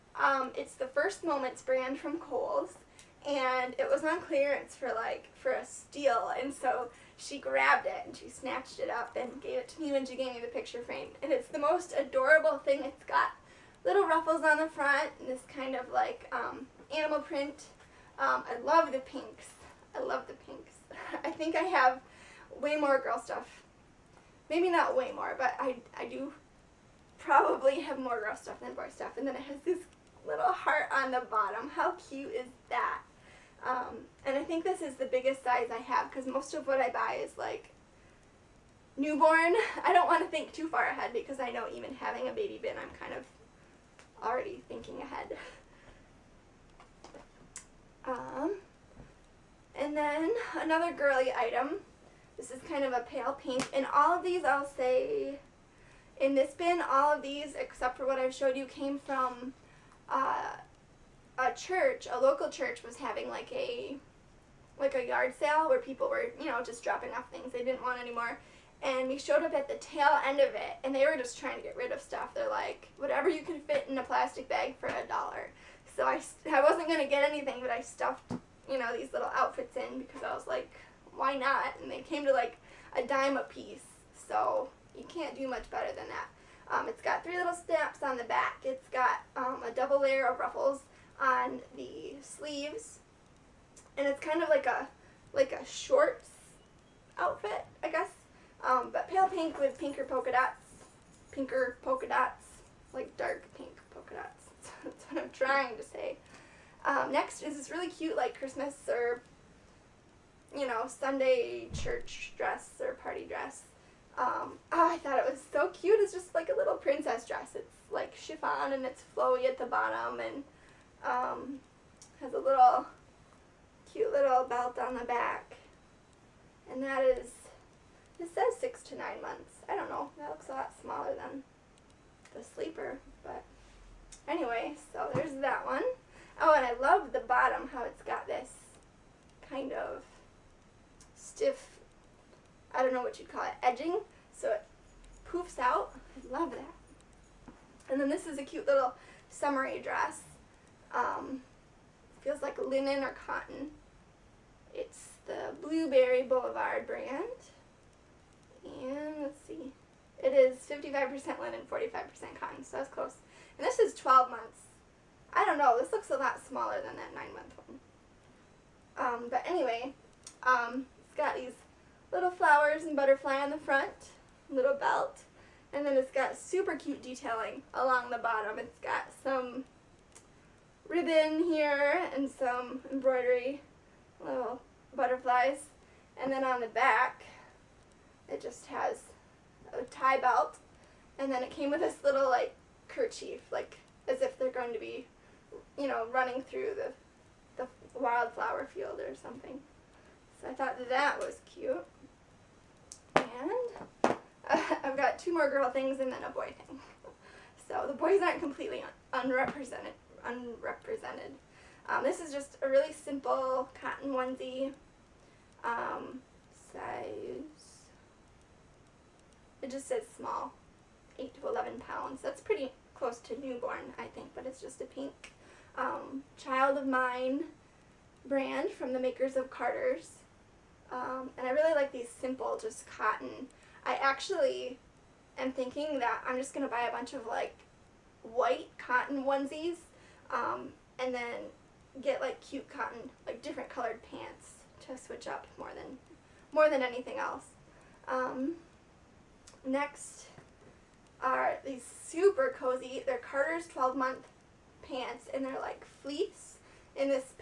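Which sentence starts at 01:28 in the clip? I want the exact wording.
It's got um, a double layer of ruffles on the sleeves.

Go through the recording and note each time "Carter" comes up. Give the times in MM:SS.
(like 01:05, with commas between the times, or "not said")
03:49, 04:13.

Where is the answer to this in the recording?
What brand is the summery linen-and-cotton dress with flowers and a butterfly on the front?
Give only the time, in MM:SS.
02:35.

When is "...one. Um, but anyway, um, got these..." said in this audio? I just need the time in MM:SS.
02:47.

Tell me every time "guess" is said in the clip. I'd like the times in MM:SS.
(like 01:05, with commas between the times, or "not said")
01:37.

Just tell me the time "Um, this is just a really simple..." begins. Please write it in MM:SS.
03:31.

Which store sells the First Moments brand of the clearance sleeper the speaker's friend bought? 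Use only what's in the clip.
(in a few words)
Kohl's.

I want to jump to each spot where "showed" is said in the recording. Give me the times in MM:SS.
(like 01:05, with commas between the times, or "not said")
00:58, 01:09.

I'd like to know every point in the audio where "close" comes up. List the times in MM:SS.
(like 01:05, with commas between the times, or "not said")
02:42, 03:42.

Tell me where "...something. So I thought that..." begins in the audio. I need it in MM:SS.
03:19.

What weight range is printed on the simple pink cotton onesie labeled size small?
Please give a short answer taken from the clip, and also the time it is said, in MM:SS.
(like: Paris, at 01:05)
8 to 11 pounds, at 03:41.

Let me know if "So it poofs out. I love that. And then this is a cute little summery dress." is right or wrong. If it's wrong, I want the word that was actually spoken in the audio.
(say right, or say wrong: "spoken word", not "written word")
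right.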